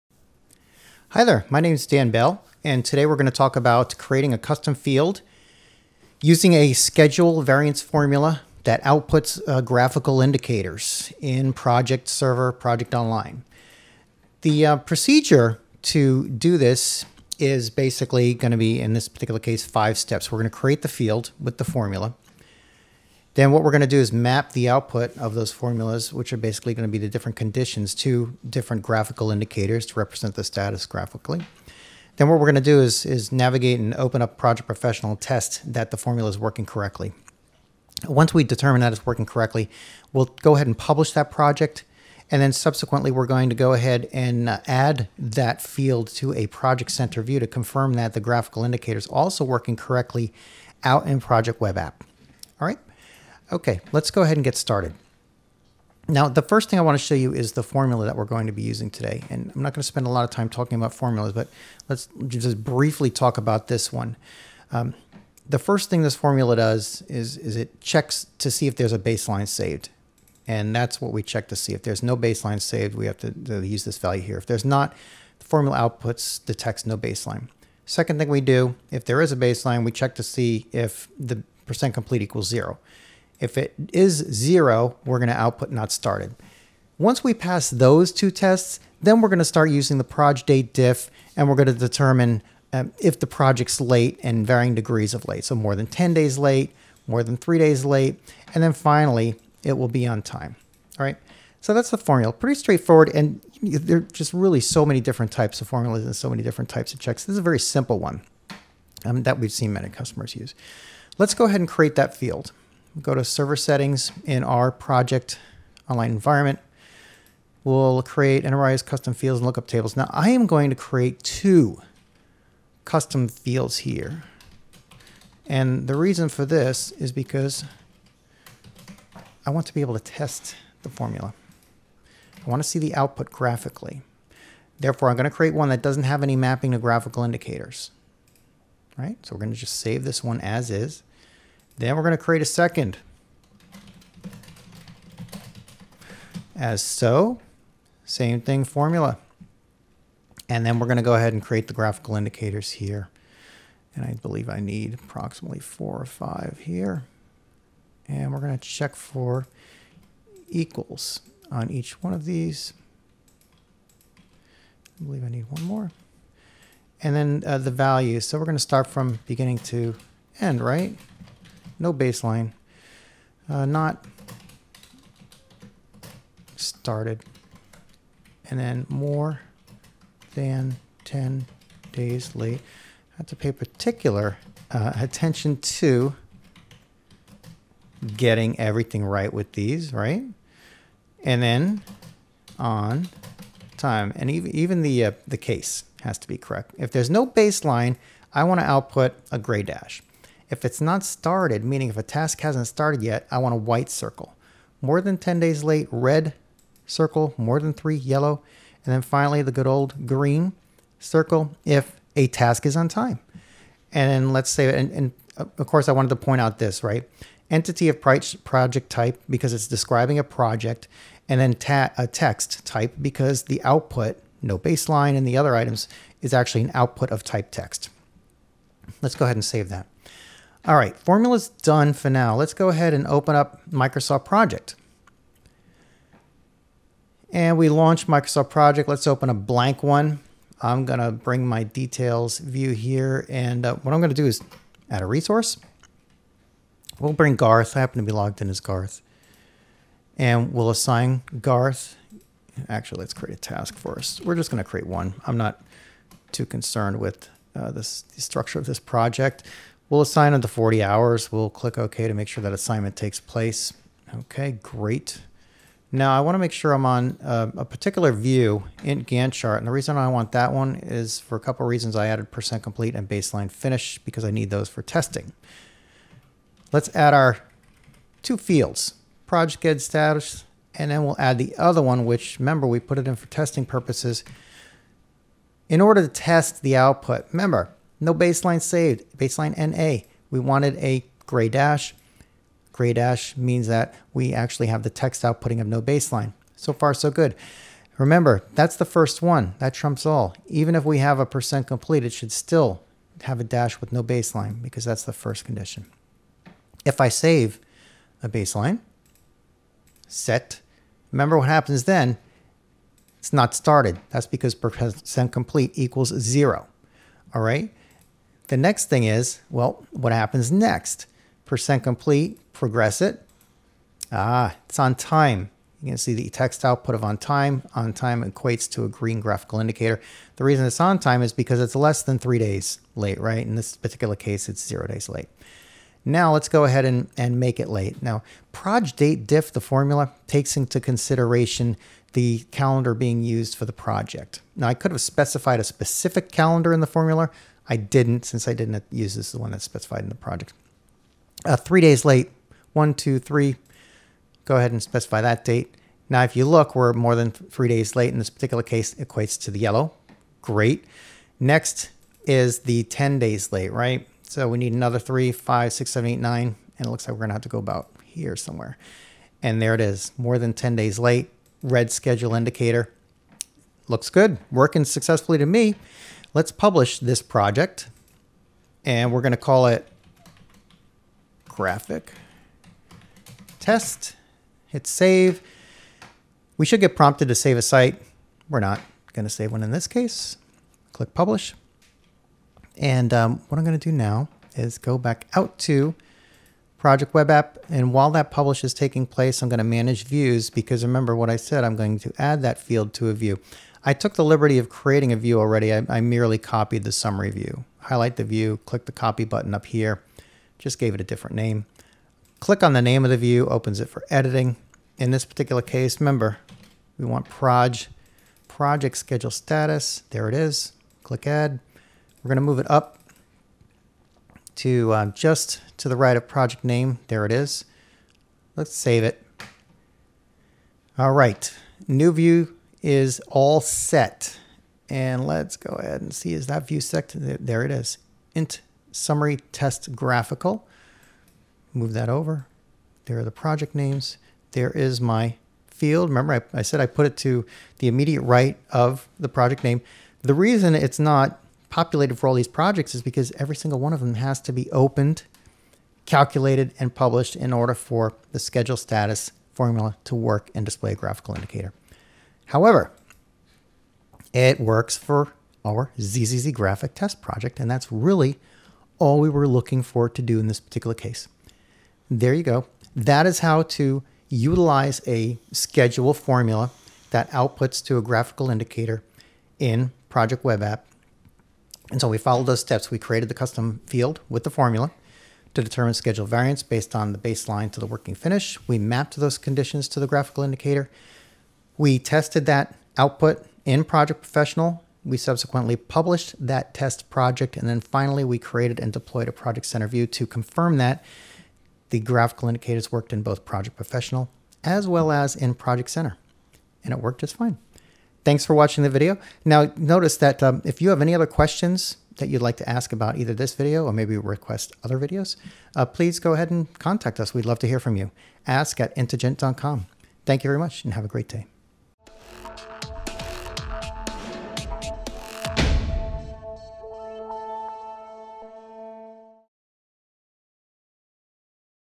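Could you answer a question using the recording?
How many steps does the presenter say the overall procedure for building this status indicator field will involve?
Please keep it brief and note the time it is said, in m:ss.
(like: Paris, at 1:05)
5, at 0:19.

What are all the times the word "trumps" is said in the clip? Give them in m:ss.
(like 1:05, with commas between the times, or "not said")
4:59.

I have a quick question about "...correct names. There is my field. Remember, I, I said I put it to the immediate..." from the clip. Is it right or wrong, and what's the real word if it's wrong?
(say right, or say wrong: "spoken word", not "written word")
wrong: "project", not "correct".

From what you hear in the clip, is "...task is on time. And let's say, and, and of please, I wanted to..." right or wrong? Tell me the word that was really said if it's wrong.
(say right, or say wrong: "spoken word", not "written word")
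wrong: "course", not "please".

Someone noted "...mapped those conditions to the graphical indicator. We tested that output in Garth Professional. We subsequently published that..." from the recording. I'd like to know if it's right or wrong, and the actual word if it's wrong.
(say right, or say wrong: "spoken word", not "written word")
wrong: "Project", not "Garth".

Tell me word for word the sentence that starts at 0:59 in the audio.
And I'm not going to spend a lot of time talking about formulas, but let's just briefly talk about this one.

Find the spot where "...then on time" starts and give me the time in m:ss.
3:11.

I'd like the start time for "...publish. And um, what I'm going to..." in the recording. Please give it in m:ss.
6:31.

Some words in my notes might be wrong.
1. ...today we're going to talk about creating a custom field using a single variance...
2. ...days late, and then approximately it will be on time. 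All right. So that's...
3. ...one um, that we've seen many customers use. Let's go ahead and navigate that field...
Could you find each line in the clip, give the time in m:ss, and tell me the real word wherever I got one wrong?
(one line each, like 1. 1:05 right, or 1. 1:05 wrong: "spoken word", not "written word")
1. 0:02 wrong: "schedule", not "single"
2. 1:37 wrong: "finally", not "approximately"
3. 1:47 wrong: "create", not "navigate".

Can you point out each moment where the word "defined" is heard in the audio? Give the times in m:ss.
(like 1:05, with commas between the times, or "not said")
not said.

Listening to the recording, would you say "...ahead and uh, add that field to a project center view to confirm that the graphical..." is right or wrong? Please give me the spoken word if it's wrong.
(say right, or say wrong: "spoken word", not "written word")
right.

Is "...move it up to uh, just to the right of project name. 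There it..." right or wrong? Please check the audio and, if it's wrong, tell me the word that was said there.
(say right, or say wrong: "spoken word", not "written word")
right.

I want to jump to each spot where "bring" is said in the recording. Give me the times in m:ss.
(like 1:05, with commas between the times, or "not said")
4:01, 4:07.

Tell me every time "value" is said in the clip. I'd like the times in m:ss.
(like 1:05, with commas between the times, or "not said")
1:13, 2:47.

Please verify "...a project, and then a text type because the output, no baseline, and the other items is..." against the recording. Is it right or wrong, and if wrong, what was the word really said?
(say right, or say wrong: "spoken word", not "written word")
right.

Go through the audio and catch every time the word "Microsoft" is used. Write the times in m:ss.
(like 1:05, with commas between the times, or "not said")
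3:53, 3:58.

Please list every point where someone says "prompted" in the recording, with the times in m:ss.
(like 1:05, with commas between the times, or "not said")
6:26.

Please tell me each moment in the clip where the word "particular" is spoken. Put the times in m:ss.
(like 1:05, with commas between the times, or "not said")
0:19, 3:03, 4:27, 5:33, 5:58, 6:55, 7:50.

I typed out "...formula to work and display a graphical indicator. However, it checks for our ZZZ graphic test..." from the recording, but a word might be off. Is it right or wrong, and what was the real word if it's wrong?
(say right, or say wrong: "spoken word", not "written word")
wrong: "works", not "checks".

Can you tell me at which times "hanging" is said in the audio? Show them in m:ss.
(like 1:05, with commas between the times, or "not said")
not said.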